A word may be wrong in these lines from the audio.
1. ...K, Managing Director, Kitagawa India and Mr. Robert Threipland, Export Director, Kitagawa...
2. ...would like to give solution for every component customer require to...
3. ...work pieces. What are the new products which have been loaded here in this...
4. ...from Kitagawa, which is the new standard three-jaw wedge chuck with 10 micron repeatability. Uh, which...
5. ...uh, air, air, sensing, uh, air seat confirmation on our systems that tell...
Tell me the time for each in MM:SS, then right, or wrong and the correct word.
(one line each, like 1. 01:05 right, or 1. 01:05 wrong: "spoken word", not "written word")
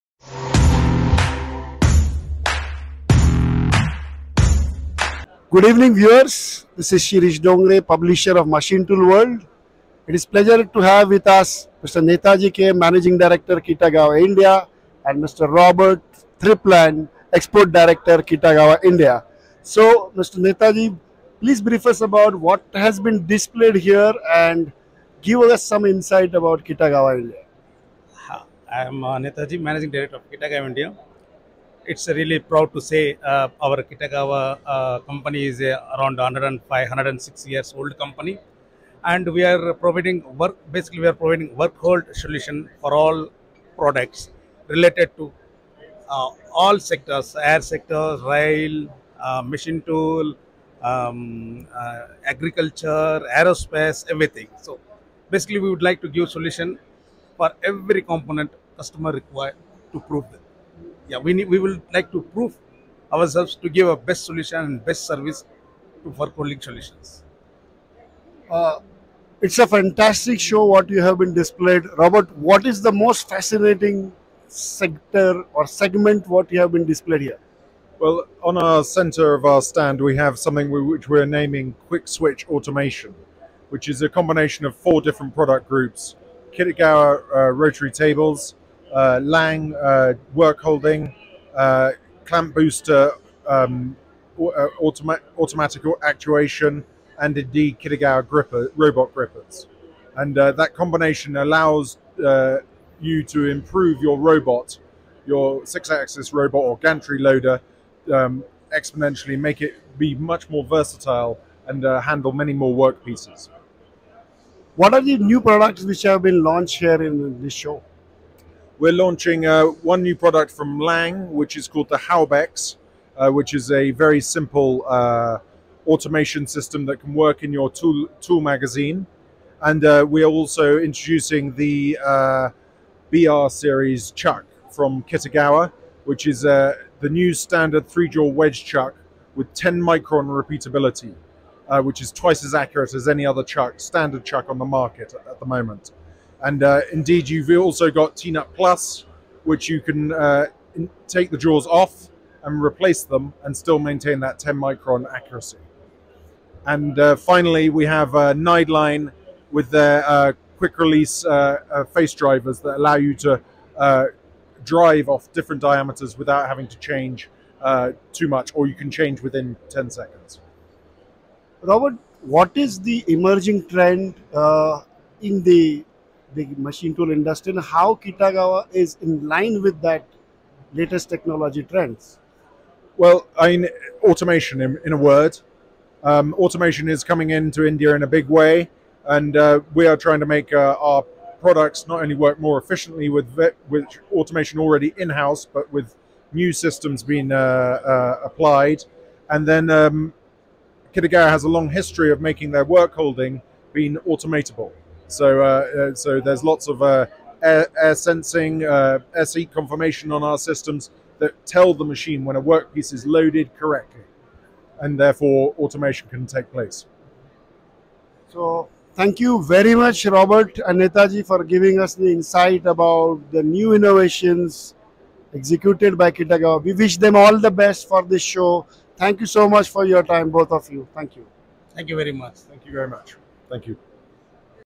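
1. 00:12 right
2. 00:55 right
3. 01:52 wrong: "launched", not "loaded"
4. 02:14 right
5. 03:26 right.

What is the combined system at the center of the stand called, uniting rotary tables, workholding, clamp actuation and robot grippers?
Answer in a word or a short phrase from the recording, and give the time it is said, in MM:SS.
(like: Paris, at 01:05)
Quick Switch Automation, at 01:21.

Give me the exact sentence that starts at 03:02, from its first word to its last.
Well, I mean, automation in, in a word.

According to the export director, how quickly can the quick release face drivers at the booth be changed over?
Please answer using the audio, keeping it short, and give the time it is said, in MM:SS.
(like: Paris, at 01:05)
10 seconds, at 02:49.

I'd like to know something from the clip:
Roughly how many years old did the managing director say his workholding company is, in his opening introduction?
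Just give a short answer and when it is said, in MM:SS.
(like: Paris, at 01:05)
105, at 00:36.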